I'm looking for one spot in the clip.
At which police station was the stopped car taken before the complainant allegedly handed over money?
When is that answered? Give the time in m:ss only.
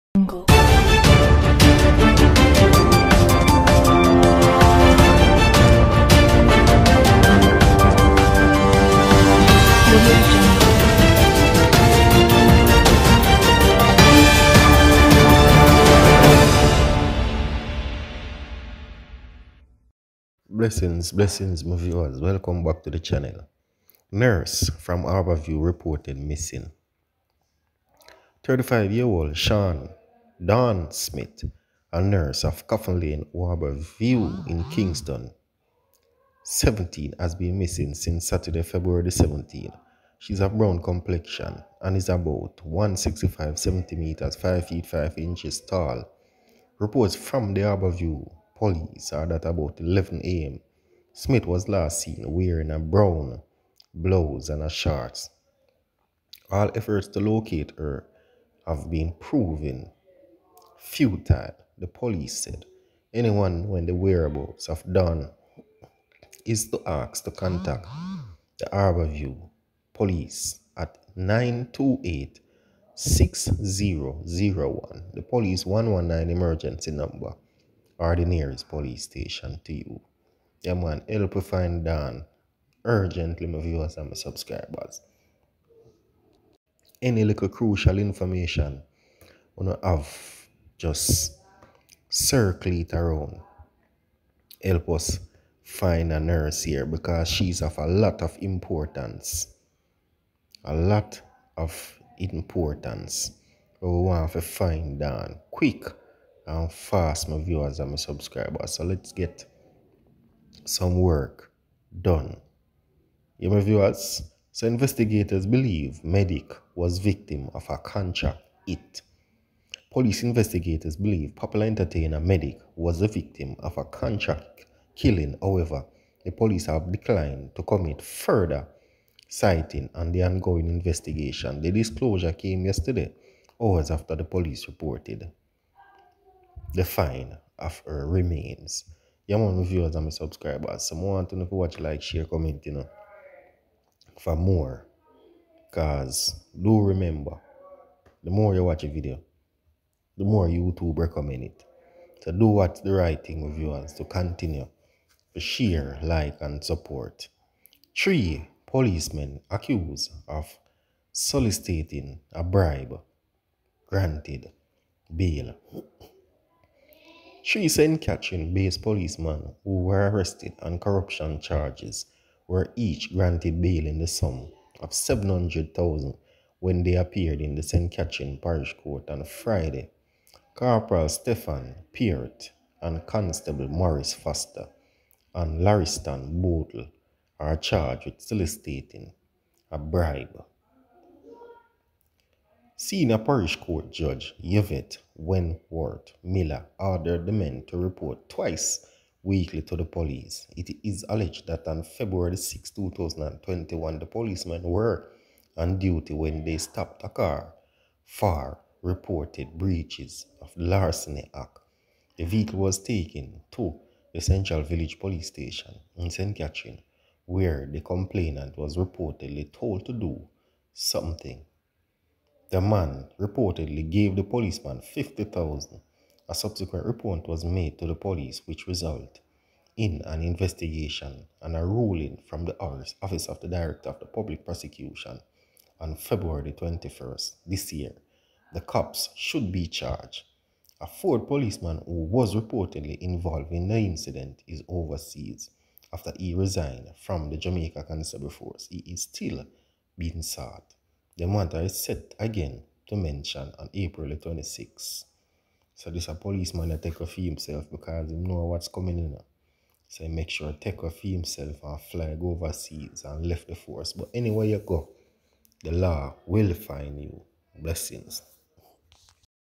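3:34.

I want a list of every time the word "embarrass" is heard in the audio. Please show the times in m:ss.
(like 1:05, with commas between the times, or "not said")
not said.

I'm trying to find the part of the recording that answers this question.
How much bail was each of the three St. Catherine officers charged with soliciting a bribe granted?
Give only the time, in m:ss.
2:54.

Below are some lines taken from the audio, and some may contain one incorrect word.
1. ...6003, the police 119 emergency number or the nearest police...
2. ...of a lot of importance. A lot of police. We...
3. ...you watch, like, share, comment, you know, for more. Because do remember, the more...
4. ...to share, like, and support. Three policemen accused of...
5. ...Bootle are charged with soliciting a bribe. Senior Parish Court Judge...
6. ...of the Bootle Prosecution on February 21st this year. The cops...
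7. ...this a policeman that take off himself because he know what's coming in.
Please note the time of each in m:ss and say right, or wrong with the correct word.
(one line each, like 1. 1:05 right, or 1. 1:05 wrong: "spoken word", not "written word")
1. 1:12 wrong: "6001", not "6003"
2. 1:37 wrong: "importance", not "police"
3. 2:21 right
4. 2:35 right
5. 3:06 right
6. 3:53 wrong: "Public", not "Bootle"
7. 4:15 right.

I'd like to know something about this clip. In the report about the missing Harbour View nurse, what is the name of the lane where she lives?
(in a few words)
Coffin Lane.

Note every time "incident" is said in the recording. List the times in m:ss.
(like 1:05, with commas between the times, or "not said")
4:03.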